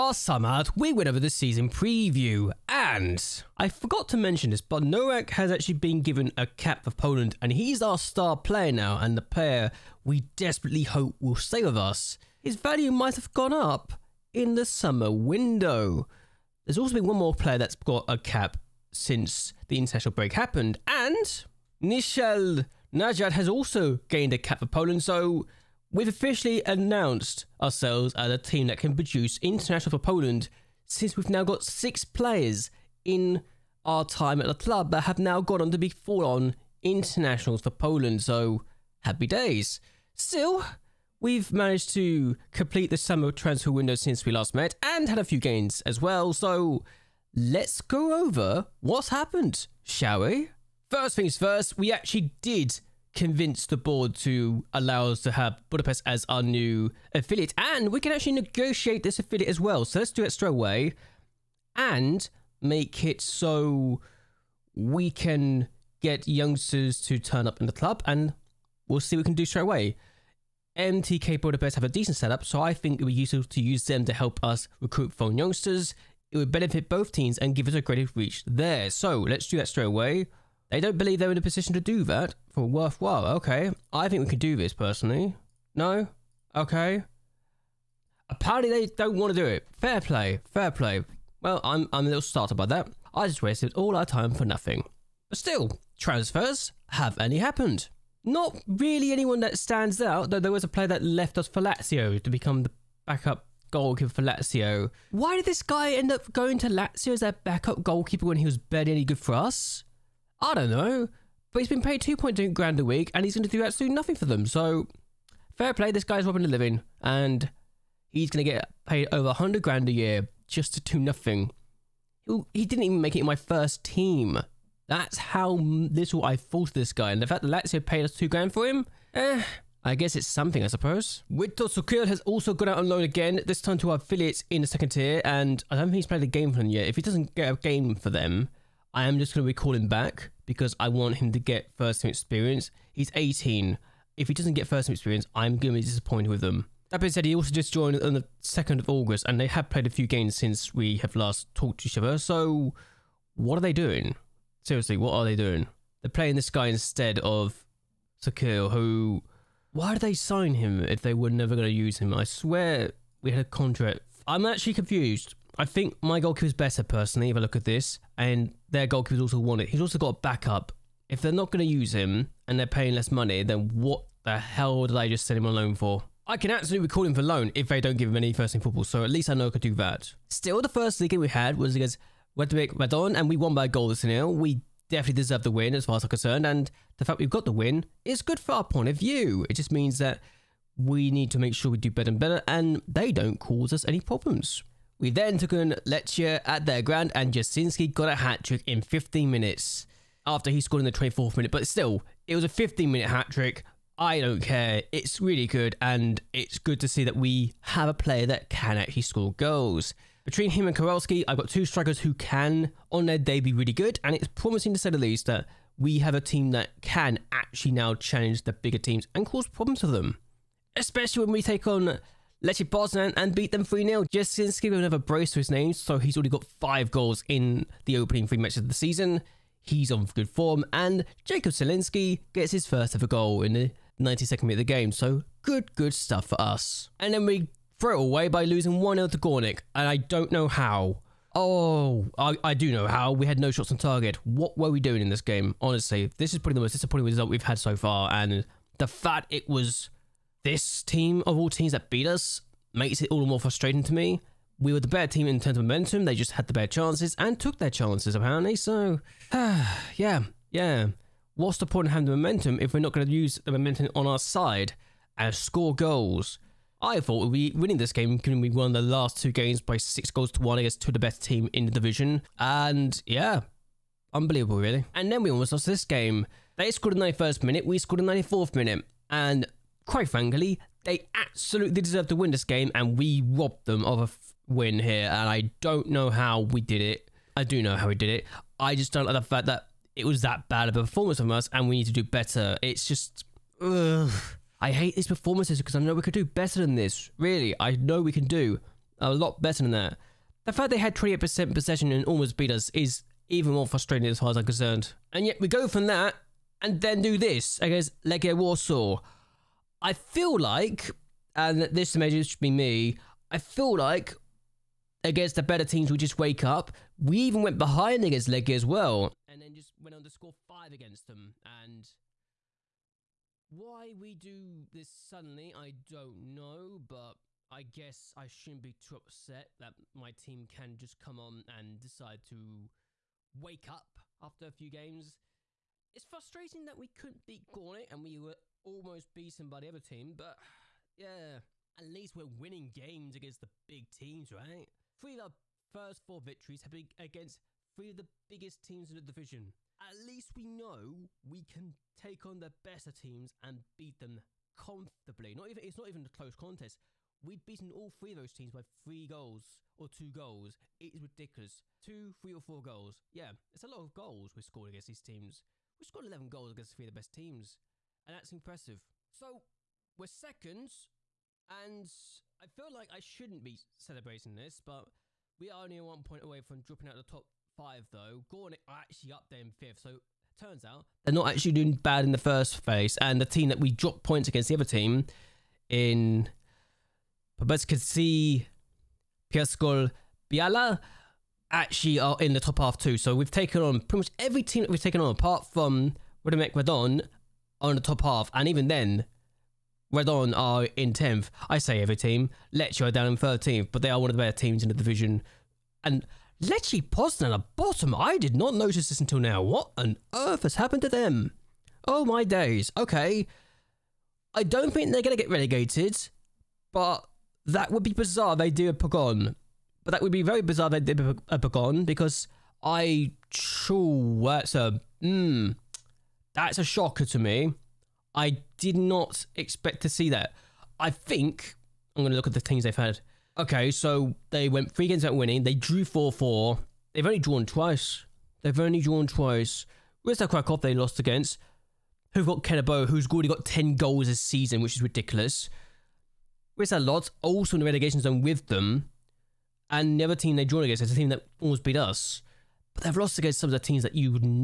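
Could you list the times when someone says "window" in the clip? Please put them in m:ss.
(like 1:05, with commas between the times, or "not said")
0:15, 0:43.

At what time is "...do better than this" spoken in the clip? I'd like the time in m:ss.
4:56.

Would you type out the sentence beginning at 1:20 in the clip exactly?
They don't believe they're in a position to do that.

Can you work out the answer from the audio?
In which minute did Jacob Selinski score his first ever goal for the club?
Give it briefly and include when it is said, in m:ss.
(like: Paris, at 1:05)
92nd minute, at 3:54.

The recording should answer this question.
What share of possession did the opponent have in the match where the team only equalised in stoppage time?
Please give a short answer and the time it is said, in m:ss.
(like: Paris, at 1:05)
28%, at 5:00.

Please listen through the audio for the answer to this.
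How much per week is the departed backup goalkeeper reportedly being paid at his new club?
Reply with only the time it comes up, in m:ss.
1:52.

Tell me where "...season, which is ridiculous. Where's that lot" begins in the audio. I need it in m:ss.
7:24.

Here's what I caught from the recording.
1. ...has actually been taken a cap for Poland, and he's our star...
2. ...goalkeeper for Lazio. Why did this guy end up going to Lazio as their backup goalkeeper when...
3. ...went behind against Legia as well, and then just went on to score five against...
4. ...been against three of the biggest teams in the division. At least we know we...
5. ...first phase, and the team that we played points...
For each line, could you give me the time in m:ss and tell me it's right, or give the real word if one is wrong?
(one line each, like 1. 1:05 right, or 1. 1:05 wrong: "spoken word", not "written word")
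1. 0:05 wrong: "given", not "taken"
2. 1:43 right
3. 5:17 right
4. 5:46 right
5. 6:22 wrong: "dropped", not "played".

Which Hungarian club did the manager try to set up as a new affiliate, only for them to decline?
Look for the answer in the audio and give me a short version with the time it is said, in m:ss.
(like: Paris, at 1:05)
MTK Budapest, at 1:10.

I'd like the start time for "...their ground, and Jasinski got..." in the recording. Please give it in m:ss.
3:16.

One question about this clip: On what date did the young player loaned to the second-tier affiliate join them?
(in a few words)
2nd of August.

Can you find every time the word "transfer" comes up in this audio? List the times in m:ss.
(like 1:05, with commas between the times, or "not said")
0:43, 1:35.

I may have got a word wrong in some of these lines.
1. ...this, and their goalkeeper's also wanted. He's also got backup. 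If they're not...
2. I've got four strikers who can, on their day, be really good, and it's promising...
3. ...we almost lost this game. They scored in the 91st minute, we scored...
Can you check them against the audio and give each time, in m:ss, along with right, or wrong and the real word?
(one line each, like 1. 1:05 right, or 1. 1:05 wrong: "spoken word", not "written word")
1. 2:47 right
2. 3:31 wrong: "two", not "four"
3. 4:35 right.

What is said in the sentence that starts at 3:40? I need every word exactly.
Especially when we take on Lechia Poznan and beat them 3-0.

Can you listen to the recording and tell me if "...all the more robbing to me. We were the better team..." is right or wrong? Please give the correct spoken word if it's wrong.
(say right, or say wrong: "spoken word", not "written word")
wrong: "frustrating", not "robbing".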